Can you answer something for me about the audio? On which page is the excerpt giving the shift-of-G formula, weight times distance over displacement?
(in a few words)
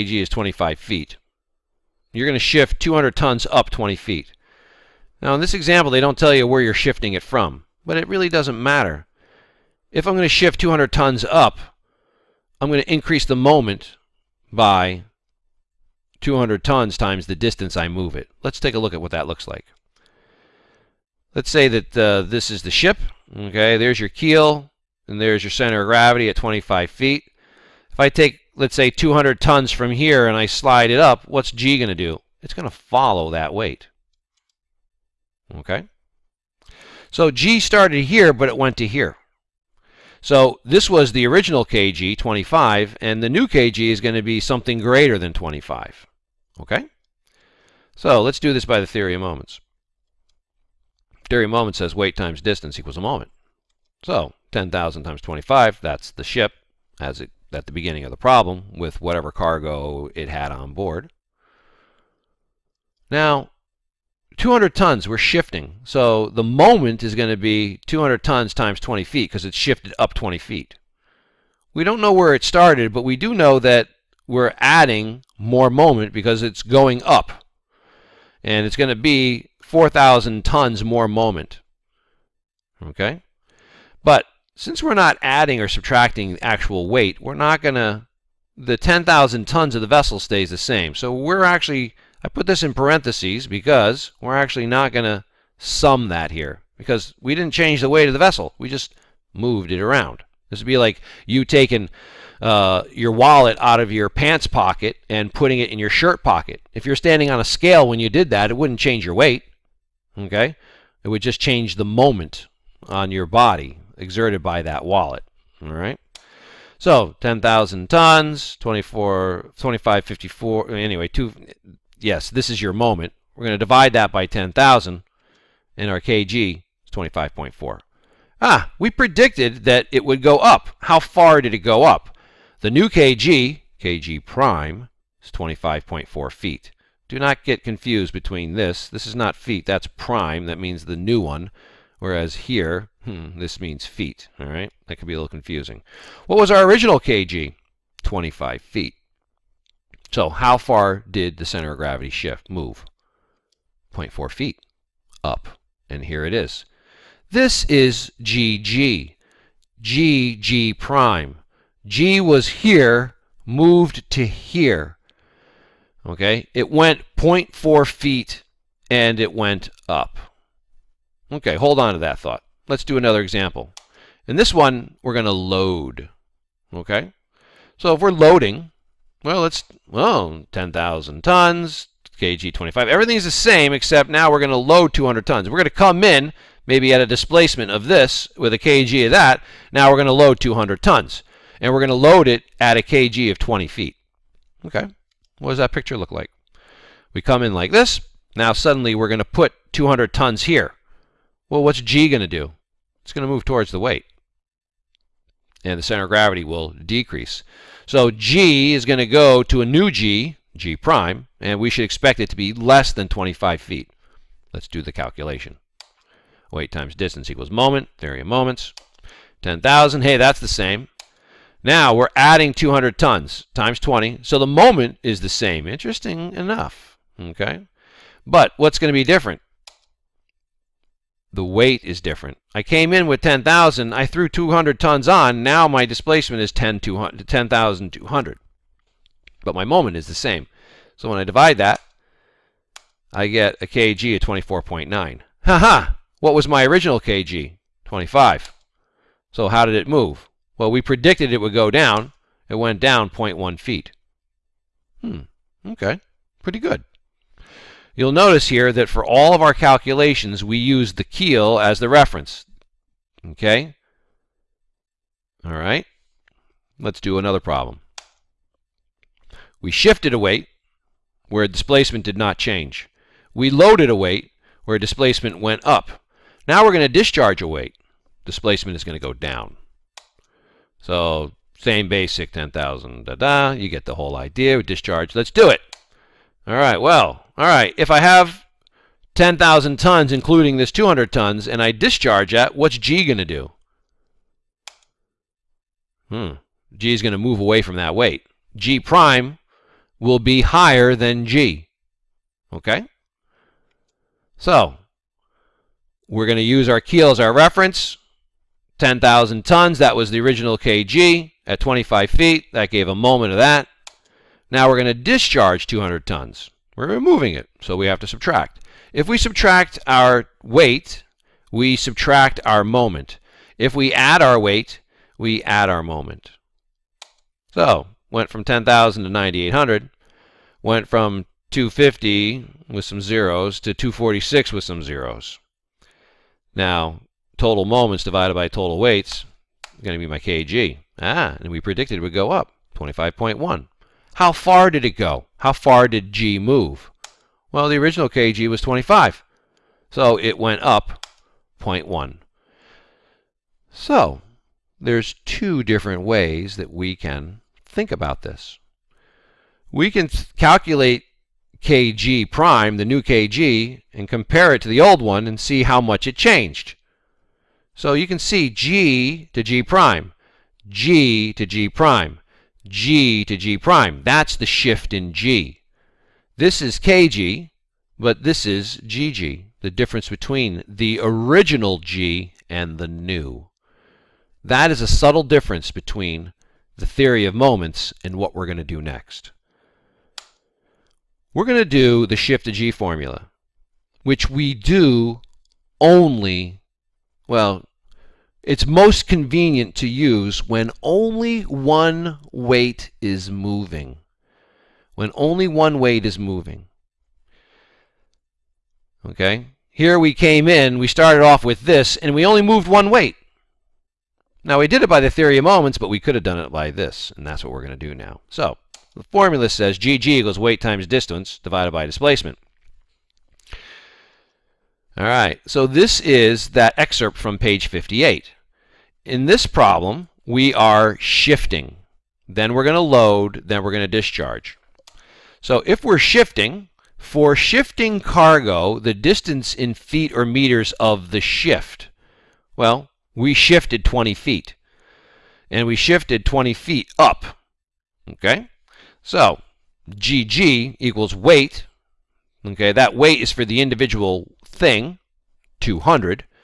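page 58.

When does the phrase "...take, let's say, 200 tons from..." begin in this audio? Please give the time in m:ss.
0:28.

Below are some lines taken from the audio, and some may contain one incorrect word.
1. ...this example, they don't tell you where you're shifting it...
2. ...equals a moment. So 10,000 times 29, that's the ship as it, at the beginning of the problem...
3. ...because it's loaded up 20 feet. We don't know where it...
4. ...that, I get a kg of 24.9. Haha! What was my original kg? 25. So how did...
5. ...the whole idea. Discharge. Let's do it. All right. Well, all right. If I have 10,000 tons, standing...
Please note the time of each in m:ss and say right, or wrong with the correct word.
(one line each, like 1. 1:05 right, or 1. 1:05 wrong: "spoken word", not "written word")
1. 0:05 right
2. 0:52 wrong: "25", not "29"
3. 1:09 wrong: "shifted", not "loaded"
4. 4:01 right
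5. 4:43 wrong: "including", not "standing".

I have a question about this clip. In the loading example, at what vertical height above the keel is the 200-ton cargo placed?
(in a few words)
20 feet.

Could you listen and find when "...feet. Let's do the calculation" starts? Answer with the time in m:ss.
3:33.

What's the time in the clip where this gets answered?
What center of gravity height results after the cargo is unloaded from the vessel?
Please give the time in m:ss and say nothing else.
5:42.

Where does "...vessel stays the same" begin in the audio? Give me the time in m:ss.
1:29.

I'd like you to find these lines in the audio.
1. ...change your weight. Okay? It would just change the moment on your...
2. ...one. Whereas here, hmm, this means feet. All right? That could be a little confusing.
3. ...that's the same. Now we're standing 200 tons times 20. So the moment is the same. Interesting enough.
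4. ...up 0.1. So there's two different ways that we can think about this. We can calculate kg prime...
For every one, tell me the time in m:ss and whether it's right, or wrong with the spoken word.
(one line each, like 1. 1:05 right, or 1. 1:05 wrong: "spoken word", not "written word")
1. 1:48 right
2. 2:21 right
3. 3:40 wrong: "adding", not "standing"
4. 5:50 right.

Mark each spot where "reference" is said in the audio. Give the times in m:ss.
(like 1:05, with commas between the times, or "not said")
4:21, 5:07.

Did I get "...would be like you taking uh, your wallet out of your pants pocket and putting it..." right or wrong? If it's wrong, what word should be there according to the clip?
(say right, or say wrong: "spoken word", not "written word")
right.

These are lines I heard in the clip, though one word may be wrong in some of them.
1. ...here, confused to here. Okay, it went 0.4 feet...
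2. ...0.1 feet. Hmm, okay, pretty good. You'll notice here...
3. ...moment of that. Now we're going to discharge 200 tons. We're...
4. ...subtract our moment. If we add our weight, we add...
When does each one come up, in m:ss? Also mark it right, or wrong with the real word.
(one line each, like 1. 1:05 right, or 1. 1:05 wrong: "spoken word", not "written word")
1. 2:42 wrong: "moved", not "confused"
2. 4:13 right
3. 5:12 right
4. 5:21 right.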